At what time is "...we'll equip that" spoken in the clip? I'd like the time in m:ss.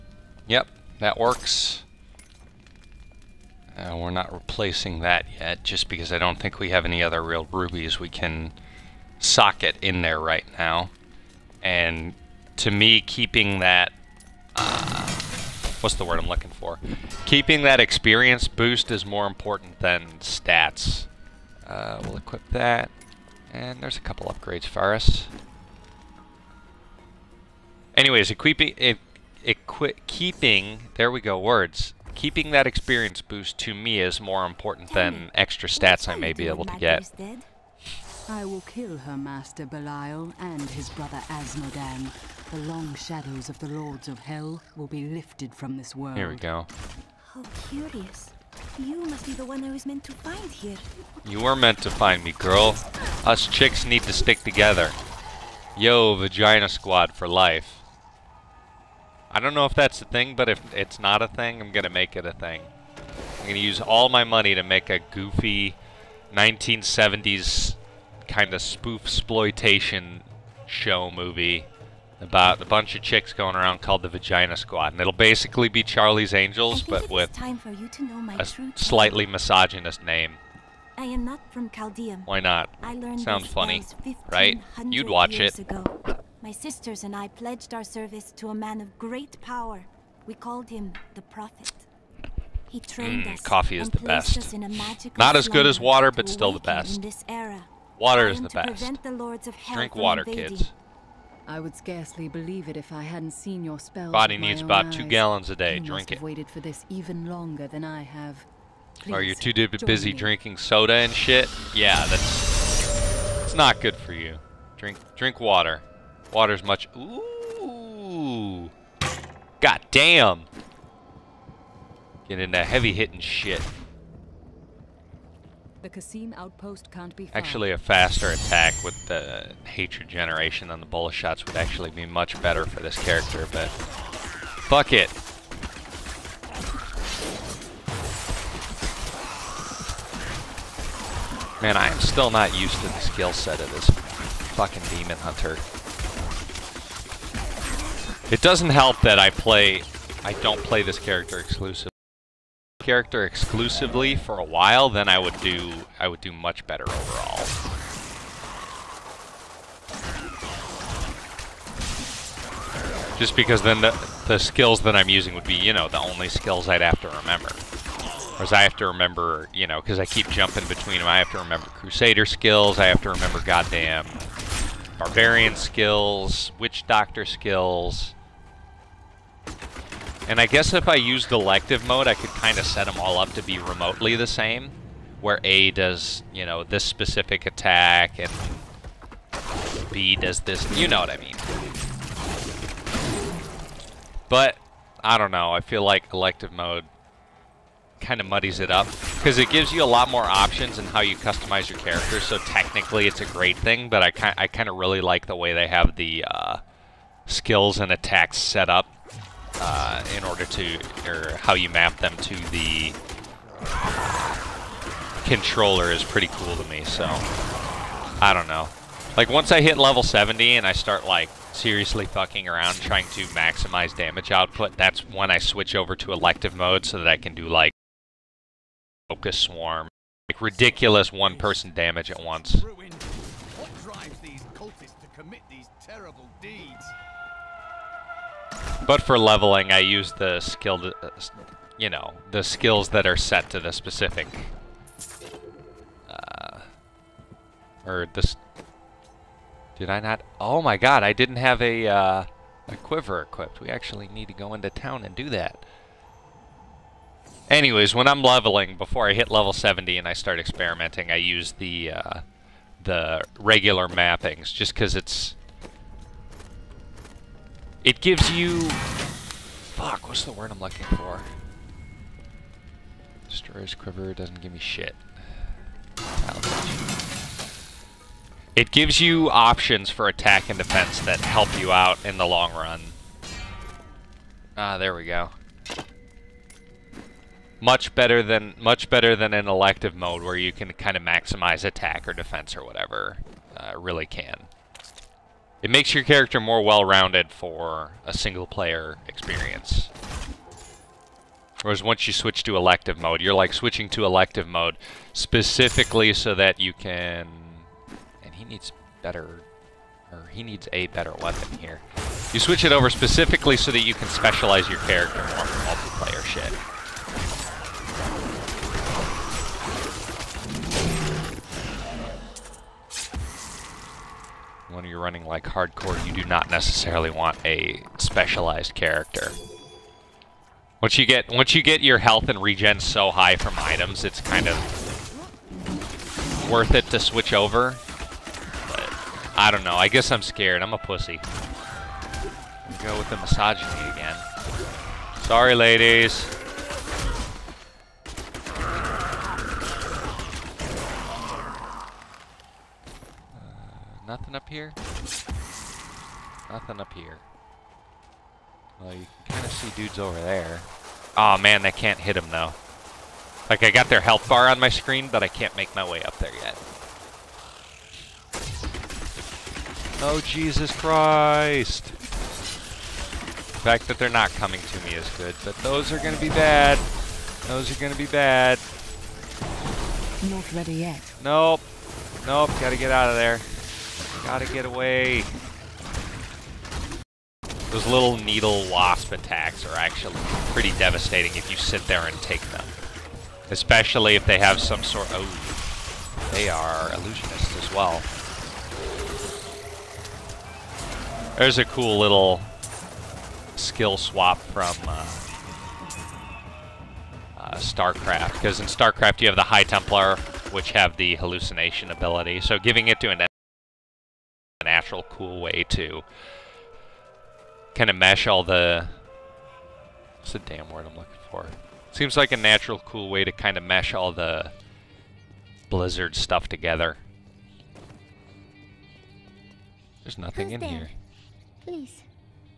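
0:22.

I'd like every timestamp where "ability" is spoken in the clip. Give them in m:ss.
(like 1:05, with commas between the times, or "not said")
6:51.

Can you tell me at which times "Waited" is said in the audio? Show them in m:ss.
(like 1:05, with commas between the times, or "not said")
1:46.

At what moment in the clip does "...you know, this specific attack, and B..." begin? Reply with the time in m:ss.
3:06.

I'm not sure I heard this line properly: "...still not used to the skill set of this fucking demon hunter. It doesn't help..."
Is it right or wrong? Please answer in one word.
right.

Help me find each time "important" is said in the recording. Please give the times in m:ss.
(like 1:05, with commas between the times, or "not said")
0:19, 0:34.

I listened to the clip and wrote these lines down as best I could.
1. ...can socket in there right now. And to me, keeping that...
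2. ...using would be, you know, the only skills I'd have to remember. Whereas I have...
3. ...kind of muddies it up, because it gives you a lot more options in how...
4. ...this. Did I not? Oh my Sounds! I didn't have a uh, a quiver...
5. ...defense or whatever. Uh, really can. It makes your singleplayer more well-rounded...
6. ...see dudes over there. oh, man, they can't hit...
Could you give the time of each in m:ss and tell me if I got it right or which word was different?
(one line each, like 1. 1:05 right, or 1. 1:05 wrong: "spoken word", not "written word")
1. 0:08 right
2. 2:45 right
3. 3:17 right
4. 4:08 wrong: "God", not "Sounds"
5. 4:52 wrong: "character", not "singleplayer"
6. 5:59 right.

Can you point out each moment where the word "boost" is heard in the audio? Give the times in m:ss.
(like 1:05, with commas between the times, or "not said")
0:18, 0:33.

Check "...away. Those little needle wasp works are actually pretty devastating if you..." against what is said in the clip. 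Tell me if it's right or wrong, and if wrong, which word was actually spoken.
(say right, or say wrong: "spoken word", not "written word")
wrong: "attacks", not "works".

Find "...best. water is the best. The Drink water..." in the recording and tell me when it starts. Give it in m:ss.
1:36.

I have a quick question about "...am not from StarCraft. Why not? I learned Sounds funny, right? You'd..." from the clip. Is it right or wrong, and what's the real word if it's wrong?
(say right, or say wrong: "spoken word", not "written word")
wrong: "Caldeum", not "StarCraft".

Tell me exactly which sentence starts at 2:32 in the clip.
Character exclusively for a while, then I would do, I would do much better overall.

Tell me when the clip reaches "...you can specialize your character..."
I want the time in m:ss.
5:13.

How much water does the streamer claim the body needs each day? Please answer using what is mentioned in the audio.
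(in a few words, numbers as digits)
2 gallons.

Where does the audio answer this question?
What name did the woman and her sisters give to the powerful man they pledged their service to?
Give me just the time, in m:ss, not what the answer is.
1:31.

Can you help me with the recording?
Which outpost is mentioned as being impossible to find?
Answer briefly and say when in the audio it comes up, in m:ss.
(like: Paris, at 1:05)
Khasim outpost, at 2:05.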